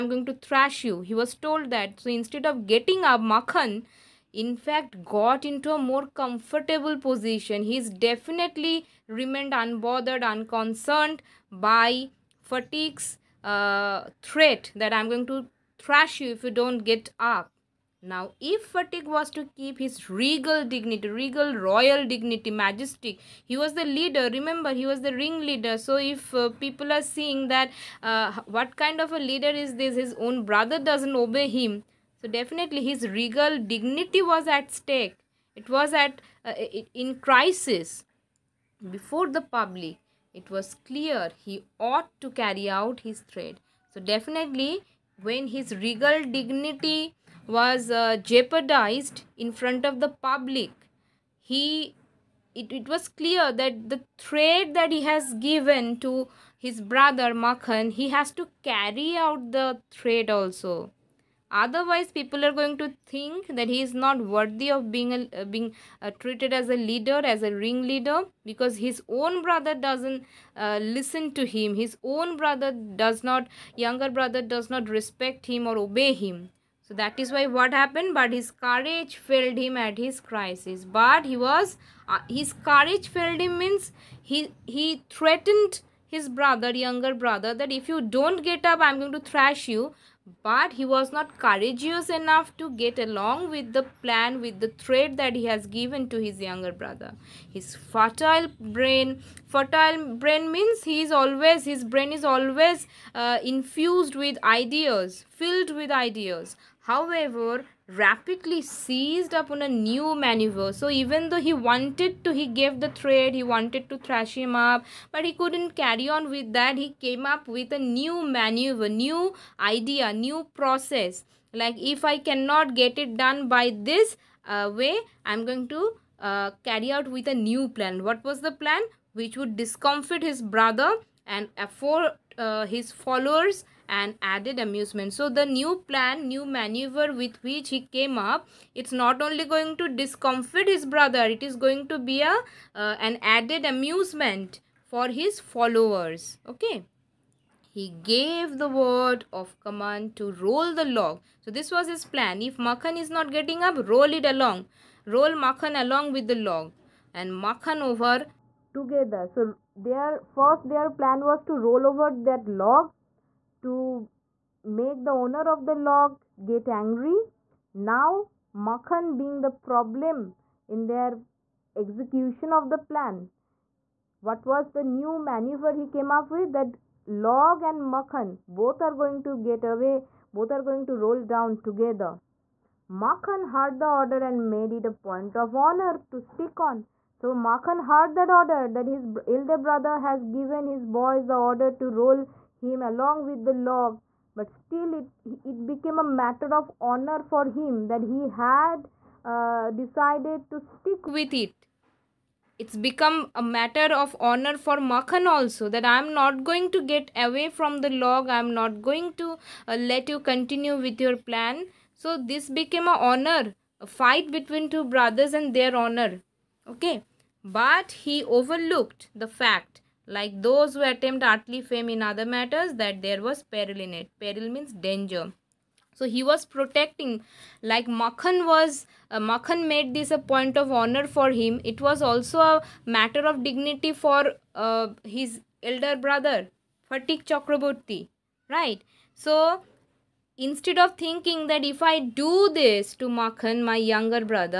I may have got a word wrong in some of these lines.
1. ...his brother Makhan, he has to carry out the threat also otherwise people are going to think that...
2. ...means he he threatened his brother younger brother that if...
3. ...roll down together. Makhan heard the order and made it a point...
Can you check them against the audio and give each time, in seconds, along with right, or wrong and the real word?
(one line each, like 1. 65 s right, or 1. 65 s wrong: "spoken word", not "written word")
1. 56 s right
2. 83 s right
3. 180 s right.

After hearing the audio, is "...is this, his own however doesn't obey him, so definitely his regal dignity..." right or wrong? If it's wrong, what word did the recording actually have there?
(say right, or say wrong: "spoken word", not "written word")
wrong: "brother", not "however".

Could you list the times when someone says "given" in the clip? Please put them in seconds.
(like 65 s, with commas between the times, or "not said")
55 s, 95 s, 190 s.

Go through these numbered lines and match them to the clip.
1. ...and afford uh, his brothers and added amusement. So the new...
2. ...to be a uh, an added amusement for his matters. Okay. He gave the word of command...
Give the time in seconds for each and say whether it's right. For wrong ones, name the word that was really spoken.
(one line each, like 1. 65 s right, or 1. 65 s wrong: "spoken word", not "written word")
1. 131 s wrong: "followers", not "brothers"
2. 141 s wrong: "followers", not "matters".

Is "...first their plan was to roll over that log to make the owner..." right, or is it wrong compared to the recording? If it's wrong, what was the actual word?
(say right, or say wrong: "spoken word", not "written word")
right.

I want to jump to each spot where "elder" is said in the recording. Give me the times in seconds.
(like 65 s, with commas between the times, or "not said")
189 s, 235 s.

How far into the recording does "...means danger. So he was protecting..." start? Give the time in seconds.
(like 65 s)
224 s.